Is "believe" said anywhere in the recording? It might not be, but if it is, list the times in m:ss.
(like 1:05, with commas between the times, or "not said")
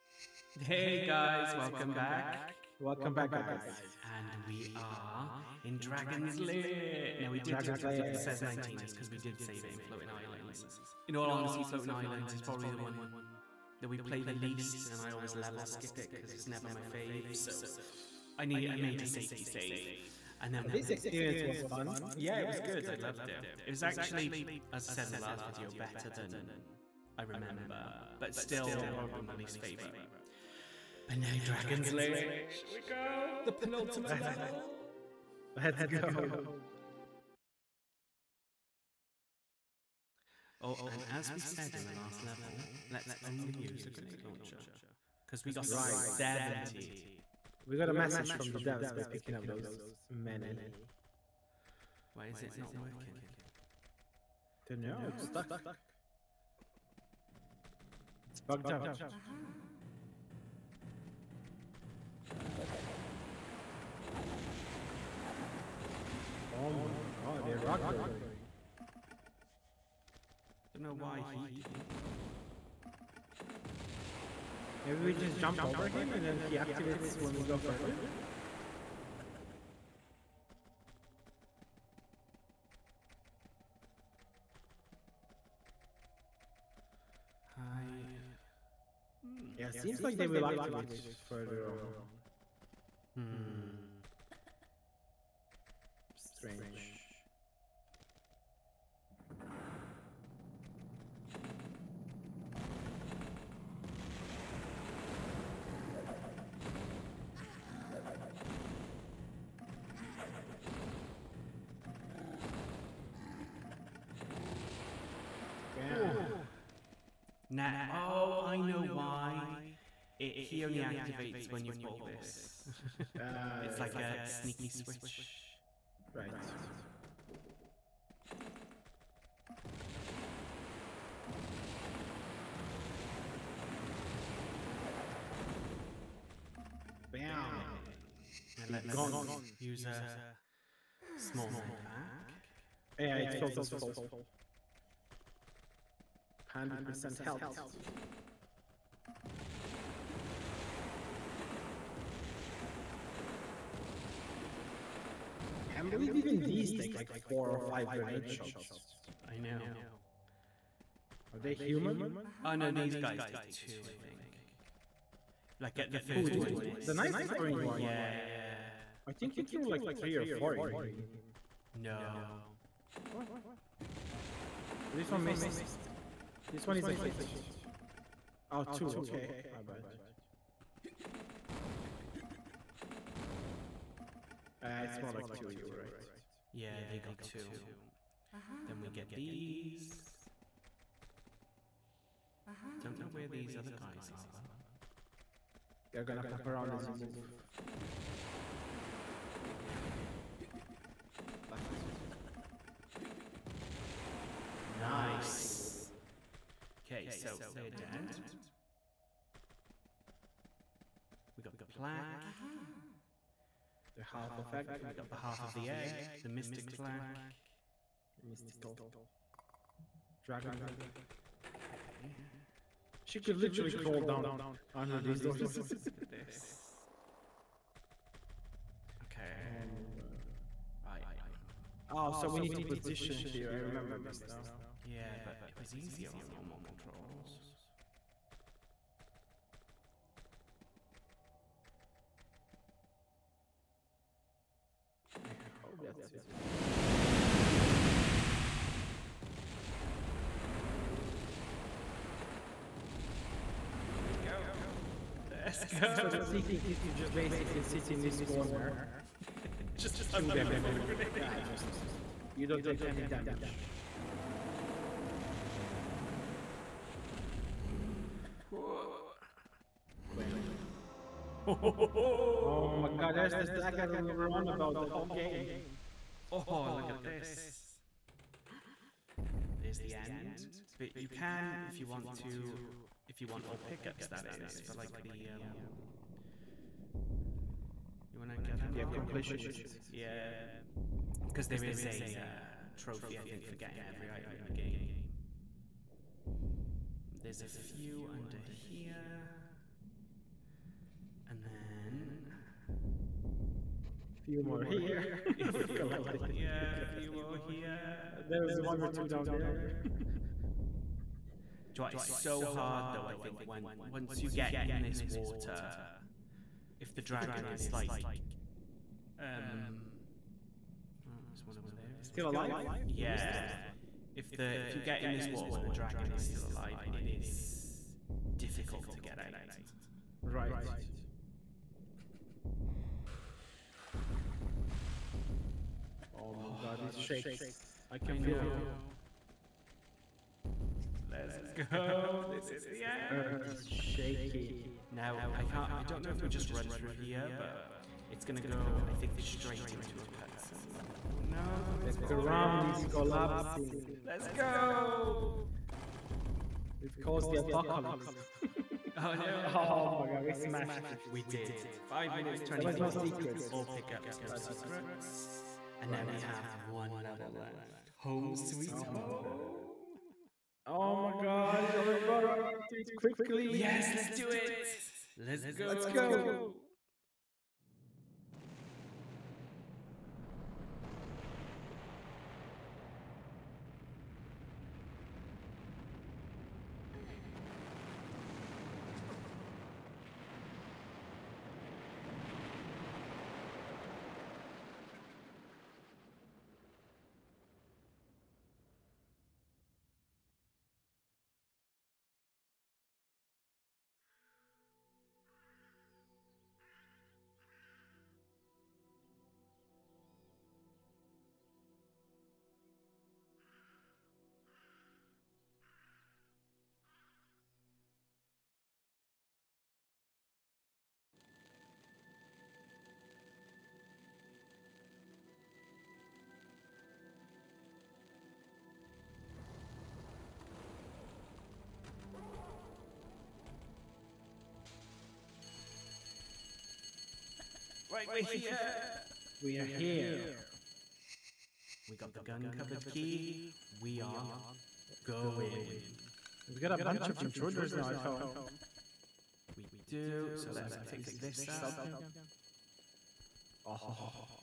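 2:35.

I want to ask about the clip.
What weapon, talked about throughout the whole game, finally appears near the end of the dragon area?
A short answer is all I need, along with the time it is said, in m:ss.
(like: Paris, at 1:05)
the dagger, at 4:33.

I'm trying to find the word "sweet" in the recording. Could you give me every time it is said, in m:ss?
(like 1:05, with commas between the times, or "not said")
6:08.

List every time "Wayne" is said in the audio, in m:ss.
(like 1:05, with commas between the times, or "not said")
not said.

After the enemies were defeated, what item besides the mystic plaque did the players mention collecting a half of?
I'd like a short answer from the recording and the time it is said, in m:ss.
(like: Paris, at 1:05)
the egg, at 3:35.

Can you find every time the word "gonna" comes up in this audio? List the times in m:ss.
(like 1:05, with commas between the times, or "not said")
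3:16, 5:48.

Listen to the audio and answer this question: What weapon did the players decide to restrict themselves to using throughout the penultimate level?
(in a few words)
grenade launcher.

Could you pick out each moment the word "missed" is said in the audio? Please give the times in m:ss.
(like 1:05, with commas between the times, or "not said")
2:46, 2:55.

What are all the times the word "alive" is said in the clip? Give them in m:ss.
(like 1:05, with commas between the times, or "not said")
5:22, 5:26.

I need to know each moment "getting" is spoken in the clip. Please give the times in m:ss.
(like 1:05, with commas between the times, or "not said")
4:53.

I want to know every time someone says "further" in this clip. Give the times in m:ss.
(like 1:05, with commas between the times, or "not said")
1:17, 1:31.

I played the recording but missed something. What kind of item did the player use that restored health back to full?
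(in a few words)
small med pack.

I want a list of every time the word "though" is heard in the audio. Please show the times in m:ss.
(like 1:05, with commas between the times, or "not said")
3:14, 5:12.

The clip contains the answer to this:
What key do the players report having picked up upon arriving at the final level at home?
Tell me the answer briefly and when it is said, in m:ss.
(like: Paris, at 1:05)
gun cupboard key, at 7:22.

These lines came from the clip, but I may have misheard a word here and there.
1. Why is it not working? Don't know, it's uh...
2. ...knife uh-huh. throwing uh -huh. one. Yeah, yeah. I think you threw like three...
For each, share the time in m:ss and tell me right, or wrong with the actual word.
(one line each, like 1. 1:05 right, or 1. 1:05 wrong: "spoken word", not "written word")
1. 0:52 right
2. 2:46 right.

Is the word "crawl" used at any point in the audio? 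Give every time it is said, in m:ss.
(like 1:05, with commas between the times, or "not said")
3:43.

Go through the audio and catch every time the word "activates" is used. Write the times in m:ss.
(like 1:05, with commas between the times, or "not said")
1:16, 1:30, 2:00.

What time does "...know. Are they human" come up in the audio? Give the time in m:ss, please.
2:39.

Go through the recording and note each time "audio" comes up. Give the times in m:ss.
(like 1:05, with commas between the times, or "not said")
not said.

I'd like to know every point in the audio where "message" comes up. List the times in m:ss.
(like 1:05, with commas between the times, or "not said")
0:47.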